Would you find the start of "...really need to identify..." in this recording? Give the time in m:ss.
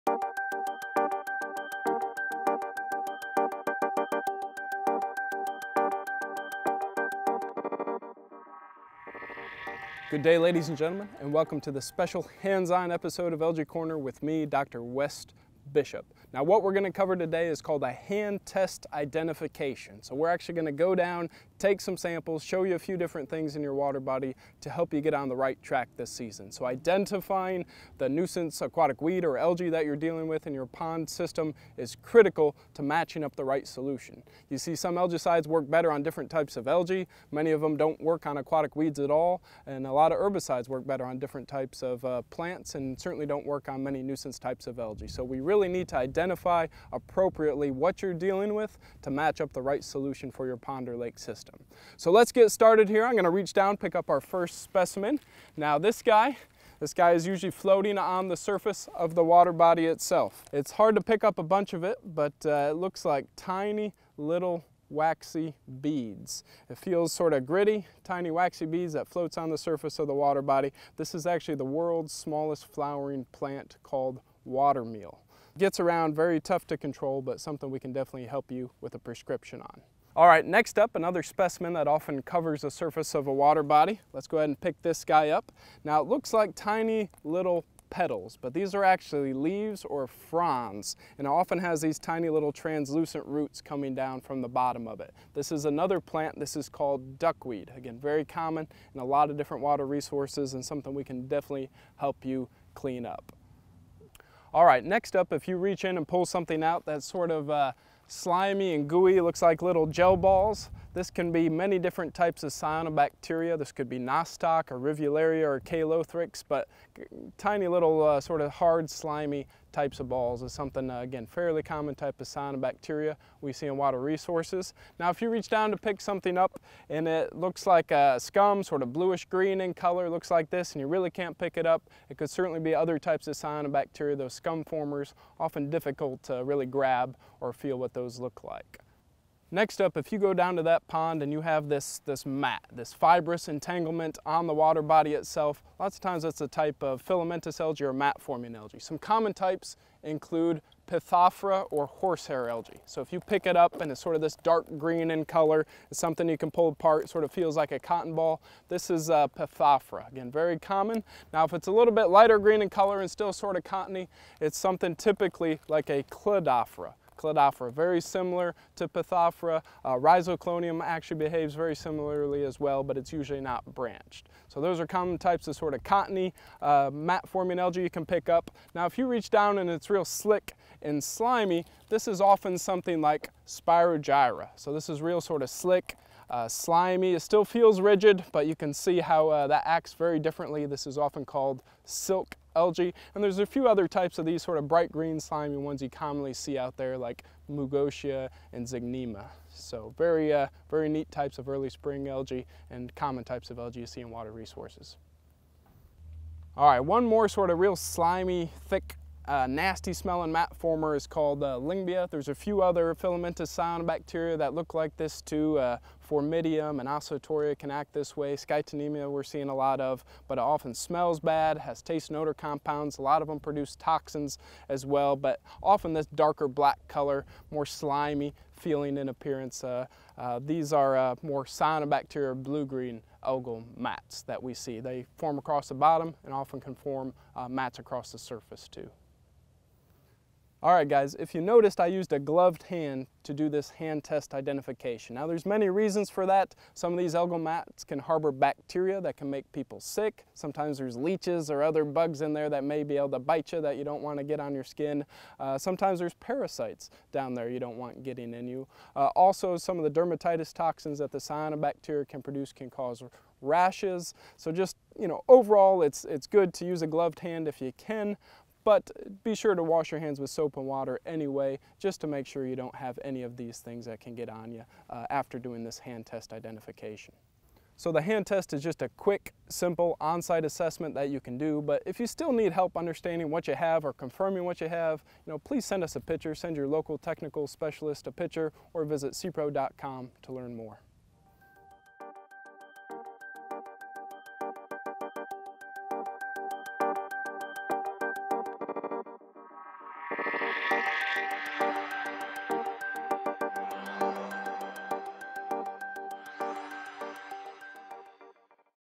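0:45.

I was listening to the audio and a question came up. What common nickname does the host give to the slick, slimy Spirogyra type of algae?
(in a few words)
Silk algae.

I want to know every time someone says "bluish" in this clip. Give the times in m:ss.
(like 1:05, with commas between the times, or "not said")
2:08.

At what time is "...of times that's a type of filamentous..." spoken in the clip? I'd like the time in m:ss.
2:25.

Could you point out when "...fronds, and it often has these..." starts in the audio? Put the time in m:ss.
1:30.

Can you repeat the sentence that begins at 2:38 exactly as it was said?
This is a uh, Pithophora, again, very common.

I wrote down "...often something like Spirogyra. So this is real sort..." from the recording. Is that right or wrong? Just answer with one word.
right.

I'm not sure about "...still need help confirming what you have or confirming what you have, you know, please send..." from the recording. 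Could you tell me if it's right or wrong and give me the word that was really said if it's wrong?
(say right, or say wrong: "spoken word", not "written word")
wrong: "understanding", not "confirming".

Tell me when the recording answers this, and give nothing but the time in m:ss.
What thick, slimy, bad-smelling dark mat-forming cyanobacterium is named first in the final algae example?
3:31.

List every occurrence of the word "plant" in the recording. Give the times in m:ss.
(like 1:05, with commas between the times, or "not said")
0:42, 1:13, 1:35.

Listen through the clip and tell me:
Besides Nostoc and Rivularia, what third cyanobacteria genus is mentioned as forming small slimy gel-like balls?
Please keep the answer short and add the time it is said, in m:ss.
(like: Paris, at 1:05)
Calothrix, at 1:55.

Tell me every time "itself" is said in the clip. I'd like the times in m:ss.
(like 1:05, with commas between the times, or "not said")
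0:59, 2:25.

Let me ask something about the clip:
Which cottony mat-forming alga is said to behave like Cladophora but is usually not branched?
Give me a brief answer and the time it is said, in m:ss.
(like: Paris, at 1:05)
Rhizoclonium, at 2:49.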